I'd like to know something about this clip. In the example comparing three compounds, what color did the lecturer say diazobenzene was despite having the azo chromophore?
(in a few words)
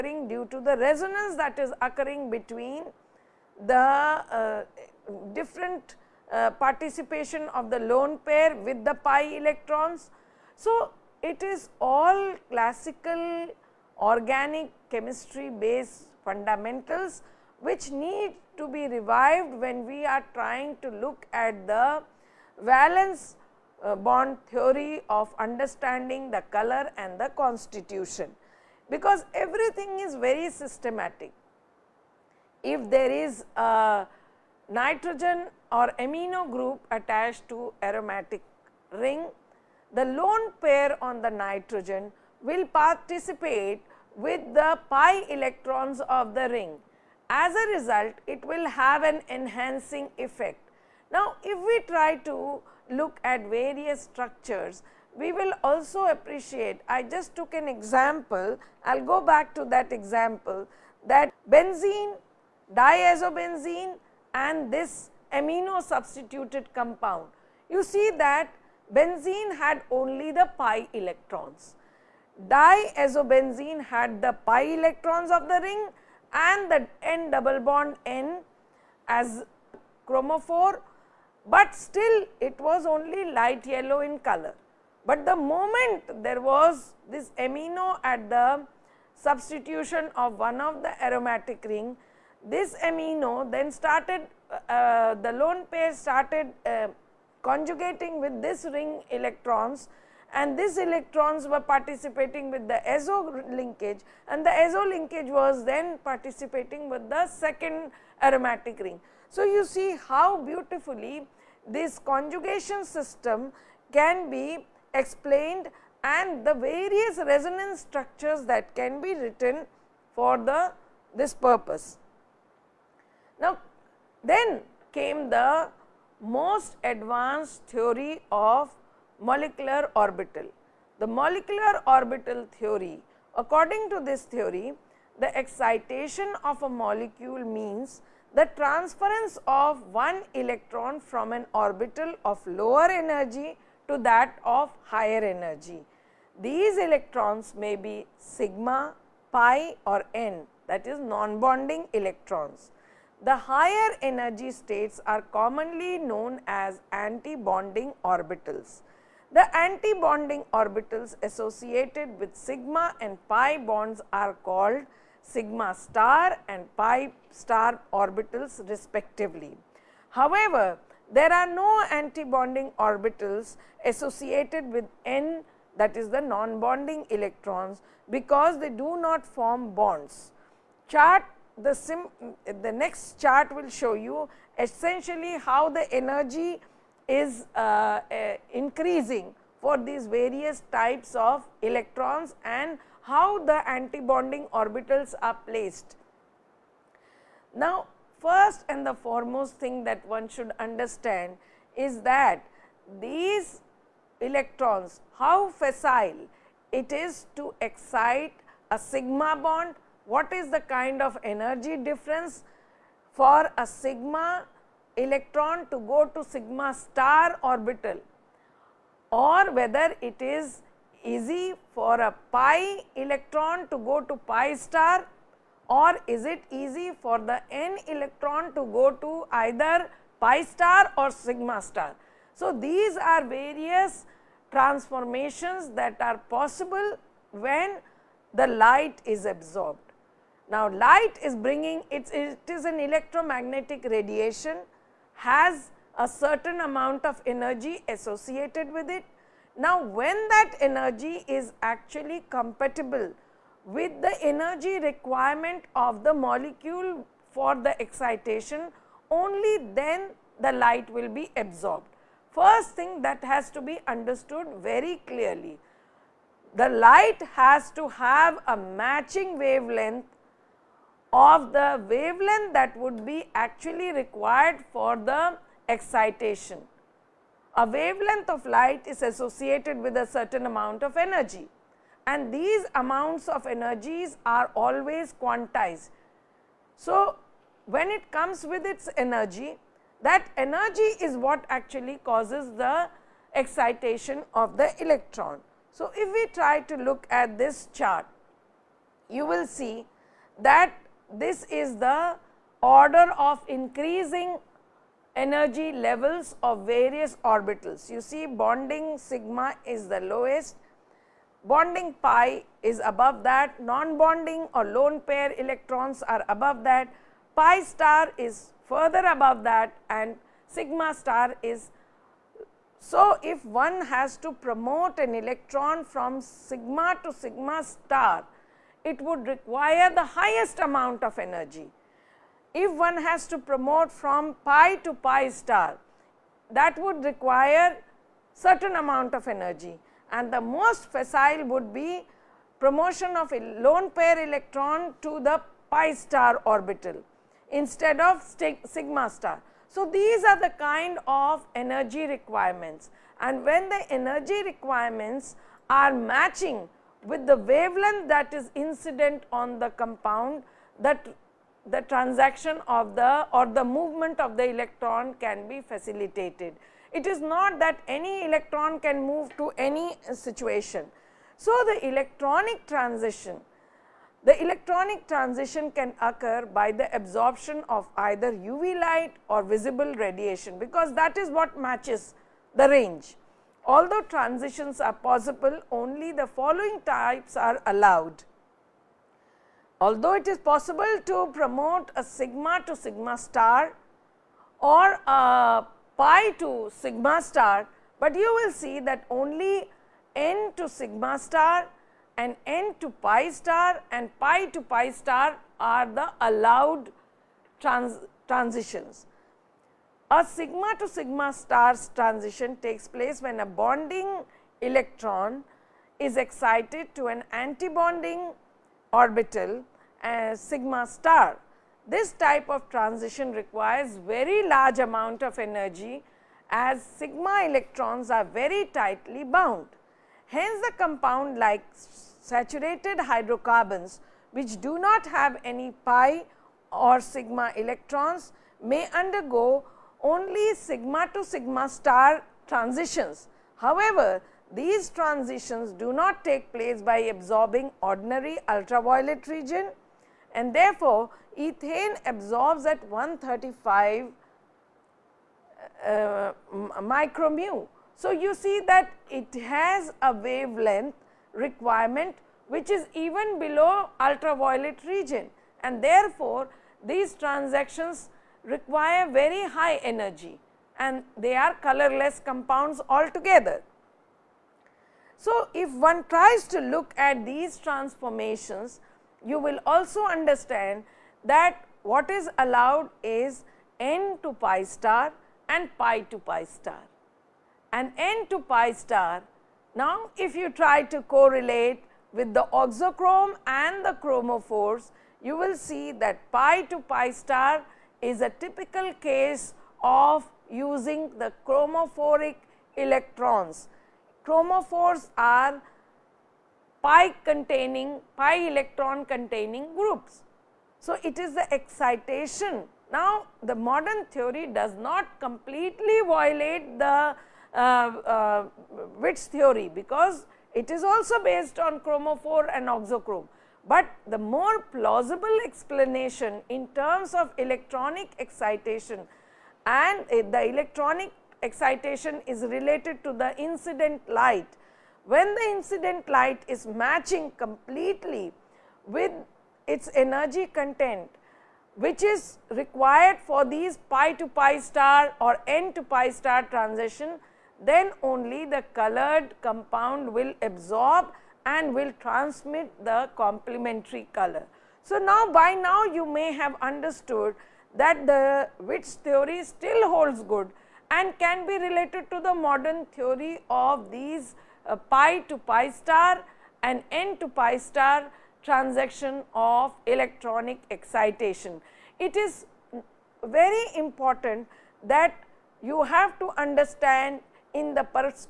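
light yellow.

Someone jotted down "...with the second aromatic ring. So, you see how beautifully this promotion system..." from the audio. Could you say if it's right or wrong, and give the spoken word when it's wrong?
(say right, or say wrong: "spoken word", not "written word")
wrong: "conjugation", not "promotion".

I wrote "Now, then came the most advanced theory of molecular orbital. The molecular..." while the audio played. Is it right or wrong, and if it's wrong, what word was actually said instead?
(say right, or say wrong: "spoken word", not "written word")
right.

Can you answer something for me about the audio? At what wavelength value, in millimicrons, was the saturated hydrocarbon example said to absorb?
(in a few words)
135.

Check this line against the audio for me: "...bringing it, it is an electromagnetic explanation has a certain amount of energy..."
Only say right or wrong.
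wrong.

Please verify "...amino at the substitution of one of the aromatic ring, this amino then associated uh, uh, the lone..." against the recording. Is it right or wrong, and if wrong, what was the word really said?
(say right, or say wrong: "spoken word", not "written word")
wrong: "started", not "associated".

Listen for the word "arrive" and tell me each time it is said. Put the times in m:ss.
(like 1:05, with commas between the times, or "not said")
not said.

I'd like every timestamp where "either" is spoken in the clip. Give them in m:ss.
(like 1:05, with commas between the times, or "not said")
3:49, 6:17.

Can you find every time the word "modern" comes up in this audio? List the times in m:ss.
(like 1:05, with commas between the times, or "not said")
8:33, 9:22.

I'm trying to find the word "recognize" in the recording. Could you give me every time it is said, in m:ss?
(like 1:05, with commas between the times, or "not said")
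not said.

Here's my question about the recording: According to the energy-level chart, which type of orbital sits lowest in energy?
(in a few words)
bonding sigma.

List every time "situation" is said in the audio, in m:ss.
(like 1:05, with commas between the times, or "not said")
6:10.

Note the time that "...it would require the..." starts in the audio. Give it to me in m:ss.
5:28.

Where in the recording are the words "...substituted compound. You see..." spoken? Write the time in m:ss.
1:05.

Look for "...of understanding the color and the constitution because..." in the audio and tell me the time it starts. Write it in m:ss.
0:25.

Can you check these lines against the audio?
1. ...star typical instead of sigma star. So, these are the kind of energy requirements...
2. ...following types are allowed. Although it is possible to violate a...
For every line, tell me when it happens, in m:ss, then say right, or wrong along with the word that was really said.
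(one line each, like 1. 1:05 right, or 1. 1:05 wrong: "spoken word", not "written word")
1. 5:46 wrong: "orbital", not "typical"
2. 6:26 wrong: "promote", not "violate".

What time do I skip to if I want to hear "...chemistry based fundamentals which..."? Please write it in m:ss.
0:14.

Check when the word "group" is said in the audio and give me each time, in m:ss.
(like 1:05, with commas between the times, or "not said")
0:36, 8:29.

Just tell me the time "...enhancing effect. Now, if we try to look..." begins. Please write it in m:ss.
0:49.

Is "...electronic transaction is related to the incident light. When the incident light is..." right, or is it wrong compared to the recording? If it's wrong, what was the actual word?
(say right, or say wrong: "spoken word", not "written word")
wrong: "excitation", not "transaction".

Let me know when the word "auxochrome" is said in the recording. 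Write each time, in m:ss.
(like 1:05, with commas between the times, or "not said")
8:12, 8:42.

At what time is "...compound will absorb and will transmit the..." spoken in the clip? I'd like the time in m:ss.
9:09.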